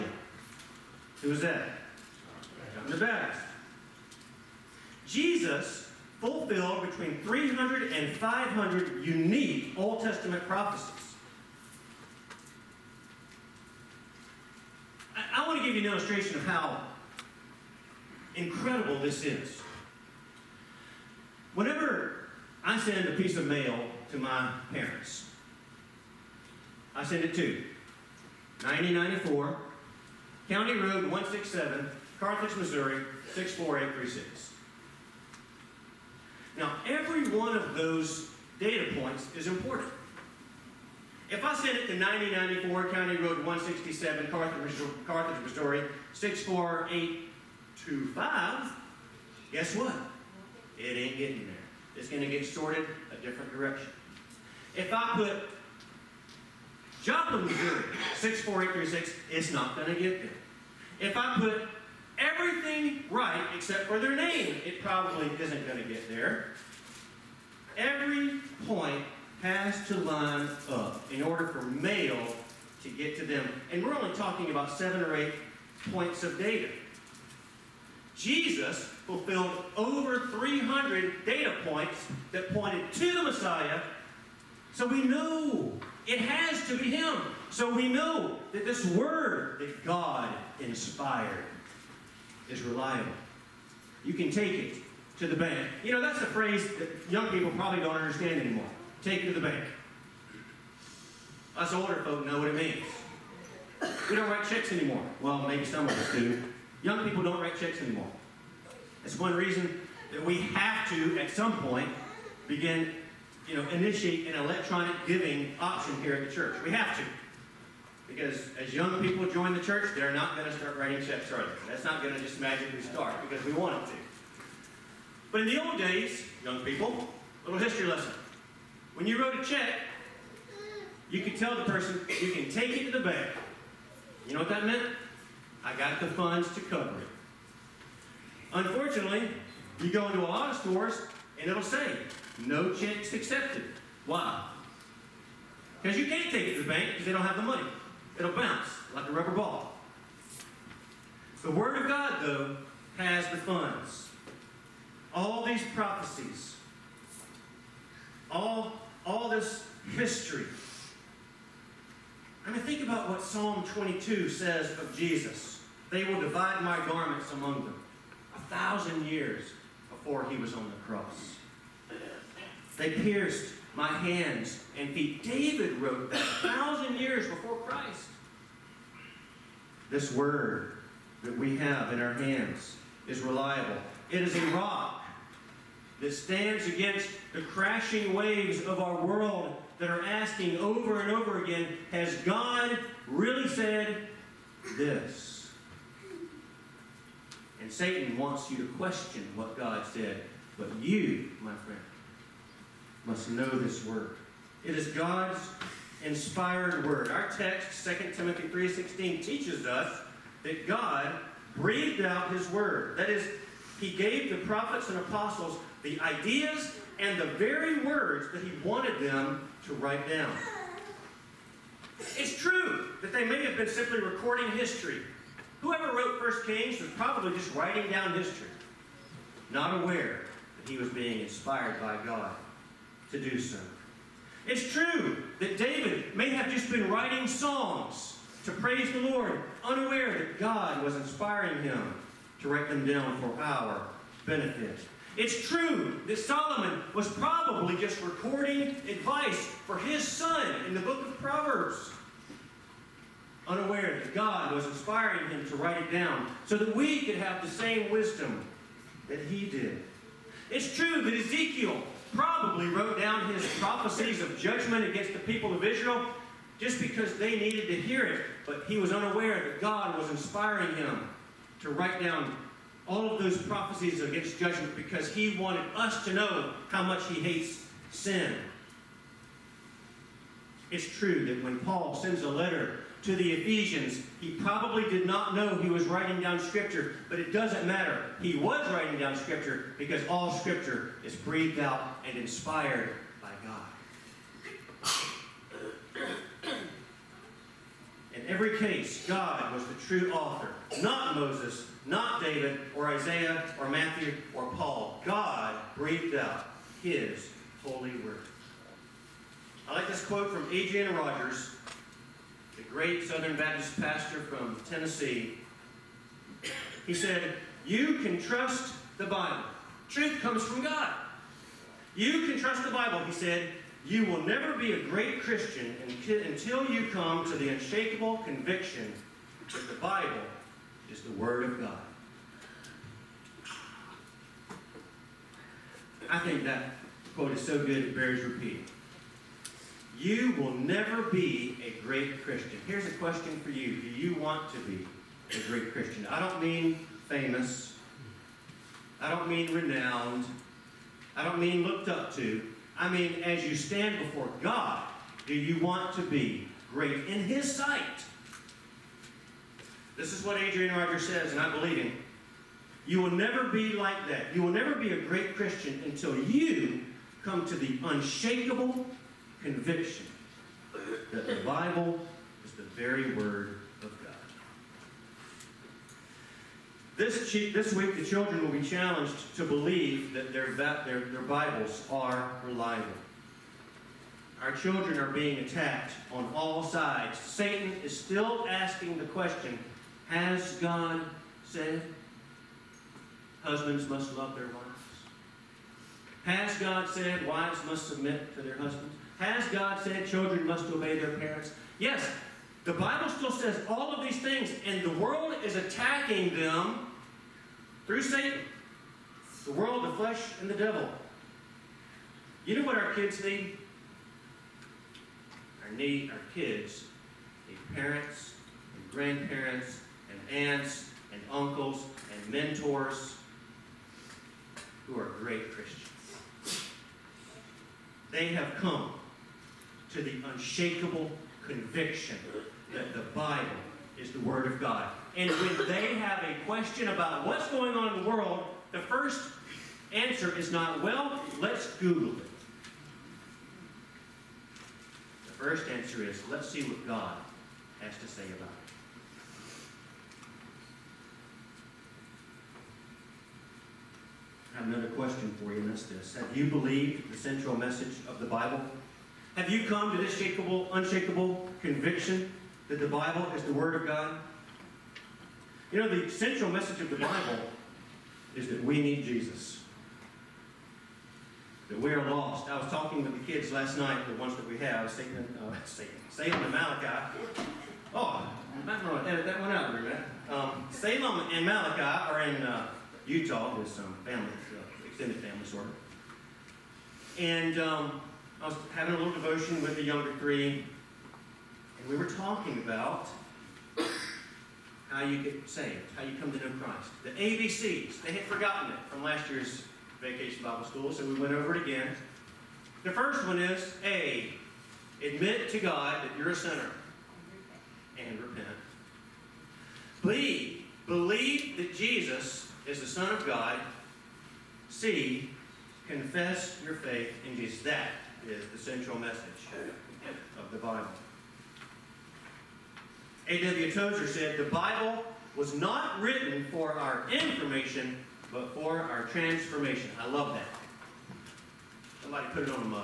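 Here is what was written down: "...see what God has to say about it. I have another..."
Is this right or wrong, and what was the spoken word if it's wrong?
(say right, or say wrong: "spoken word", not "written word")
right.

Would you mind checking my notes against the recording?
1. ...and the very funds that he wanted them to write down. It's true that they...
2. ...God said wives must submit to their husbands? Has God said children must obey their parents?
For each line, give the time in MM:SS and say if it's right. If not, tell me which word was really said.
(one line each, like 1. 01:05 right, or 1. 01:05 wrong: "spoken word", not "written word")
1. 03:36 wrong: "words", not "funds"
2. 06:36 right.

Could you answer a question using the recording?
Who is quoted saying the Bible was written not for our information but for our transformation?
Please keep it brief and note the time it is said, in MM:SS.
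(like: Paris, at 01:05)
A.W. Tozer, at 08:43.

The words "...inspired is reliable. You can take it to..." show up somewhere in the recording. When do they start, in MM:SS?
01:30.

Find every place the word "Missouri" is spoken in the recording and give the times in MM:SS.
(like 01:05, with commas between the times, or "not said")
00:32, 00:45, 00:57.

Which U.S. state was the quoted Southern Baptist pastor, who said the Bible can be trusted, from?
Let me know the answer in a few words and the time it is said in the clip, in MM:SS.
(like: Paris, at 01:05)
Tennessee, at 05:14.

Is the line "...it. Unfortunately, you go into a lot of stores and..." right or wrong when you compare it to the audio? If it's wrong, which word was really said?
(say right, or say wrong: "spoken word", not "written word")
right.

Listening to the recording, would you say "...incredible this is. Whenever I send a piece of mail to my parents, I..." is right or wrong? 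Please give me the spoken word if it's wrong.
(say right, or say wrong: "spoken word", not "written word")
right.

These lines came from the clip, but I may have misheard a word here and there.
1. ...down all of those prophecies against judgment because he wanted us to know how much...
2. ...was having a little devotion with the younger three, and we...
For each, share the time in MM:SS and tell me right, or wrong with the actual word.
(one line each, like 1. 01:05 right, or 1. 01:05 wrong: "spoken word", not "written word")
1. 04:32 right
2. 08:08 right.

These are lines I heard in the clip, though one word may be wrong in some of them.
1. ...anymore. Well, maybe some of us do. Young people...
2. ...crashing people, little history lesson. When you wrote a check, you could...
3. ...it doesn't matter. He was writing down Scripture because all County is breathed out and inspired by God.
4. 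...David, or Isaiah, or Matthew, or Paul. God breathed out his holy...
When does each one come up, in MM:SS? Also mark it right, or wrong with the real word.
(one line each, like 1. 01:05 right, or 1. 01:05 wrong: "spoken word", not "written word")
1. 01:44 right
2. 02:06 wrong: "young", not "crashing"
3. 04:47 wrong: "Scripture", not "County"
4. 05:02 right.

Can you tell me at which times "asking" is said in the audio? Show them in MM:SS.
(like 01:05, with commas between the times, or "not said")
03:10, 06:28.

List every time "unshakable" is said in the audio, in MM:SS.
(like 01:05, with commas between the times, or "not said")
05:27, 06:07, 07:10, 07:40.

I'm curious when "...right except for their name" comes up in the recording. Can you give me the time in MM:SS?
01:03.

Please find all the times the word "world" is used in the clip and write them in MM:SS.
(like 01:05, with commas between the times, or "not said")
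03:09, 06:44, 06:49, 07:18.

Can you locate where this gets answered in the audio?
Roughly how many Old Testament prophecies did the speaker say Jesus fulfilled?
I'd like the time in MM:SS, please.
00:07.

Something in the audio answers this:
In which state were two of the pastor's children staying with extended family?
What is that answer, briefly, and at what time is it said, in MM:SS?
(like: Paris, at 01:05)
Utah, at 08:03.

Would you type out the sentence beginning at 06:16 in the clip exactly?
This, this week, the children will be challenged to believe that their, their, their Bibles are reliable.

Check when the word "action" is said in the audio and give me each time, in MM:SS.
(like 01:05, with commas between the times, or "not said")
not said.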